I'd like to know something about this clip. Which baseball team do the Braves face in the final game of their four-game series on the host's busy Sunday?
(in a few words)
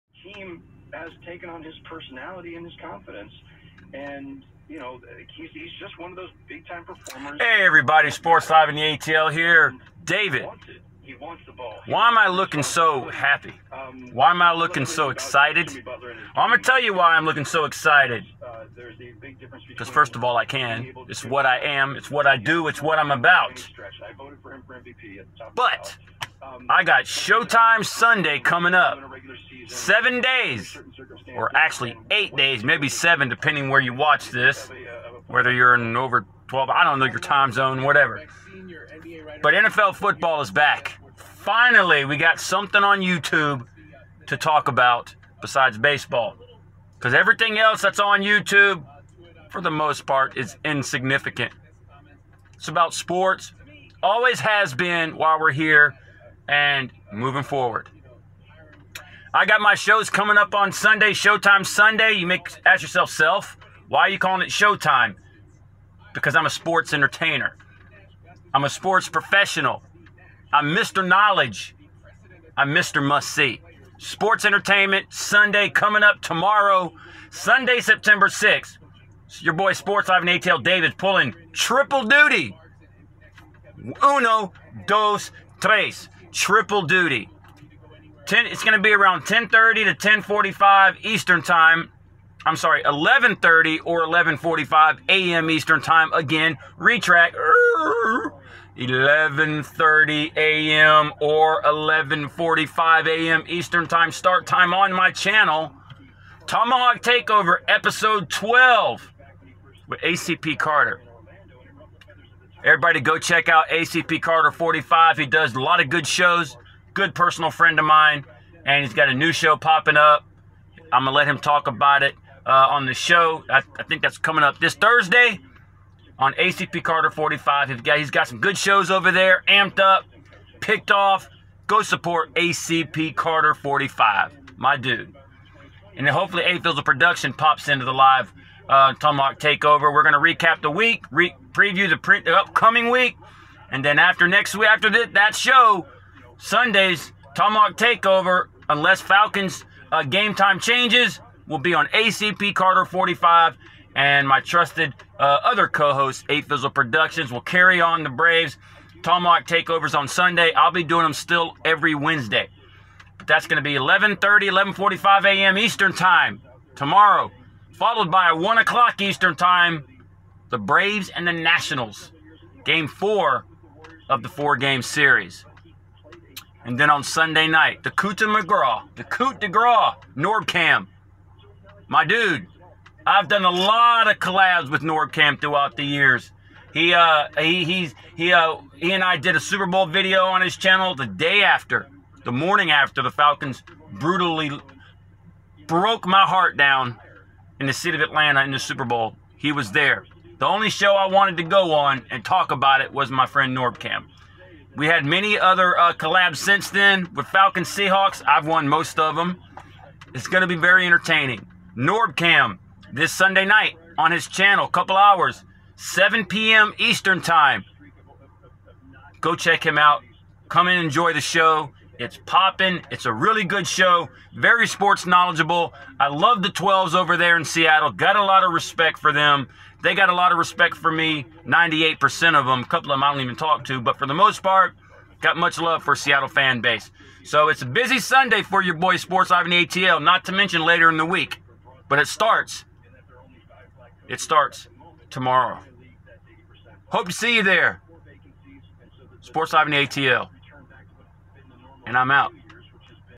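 Nationals.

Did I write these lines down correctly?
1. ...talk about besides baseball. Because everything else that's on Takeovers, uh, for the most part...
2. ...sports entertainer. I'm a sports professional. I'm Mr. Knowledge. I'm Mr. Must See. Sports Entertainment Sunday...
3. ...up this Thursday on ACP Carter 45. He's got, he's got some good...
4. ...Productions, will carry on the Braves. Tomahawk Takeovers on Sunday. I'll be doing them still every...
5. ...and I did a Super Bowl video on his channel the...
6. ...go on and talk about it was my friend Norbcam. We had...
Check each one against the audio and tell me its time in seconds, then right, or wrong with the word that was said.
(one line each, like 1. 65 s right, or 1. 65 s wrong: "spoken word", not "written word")
1. 44 s wrong: "YouTube", not "Takeovers"
2. 66 s right
3. 124 s right
4. 156 s right
5. 188 s right
6. 201 s right.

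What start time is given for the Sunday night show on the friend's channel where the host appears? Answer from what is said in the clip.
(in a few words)
7 p.m. Eastern.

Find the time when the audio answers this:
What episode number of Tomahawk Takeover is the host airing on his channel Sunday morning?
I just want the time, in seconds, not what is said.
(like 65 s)
107 s.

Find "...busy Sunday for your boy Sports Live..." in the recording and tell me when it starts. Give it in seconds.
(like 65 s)
237 s.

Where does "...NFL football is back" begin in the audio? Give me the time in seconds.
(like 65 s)
39 s.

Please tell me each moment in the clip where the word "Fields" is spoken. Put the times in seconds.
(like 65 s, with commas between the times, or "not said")
136 s.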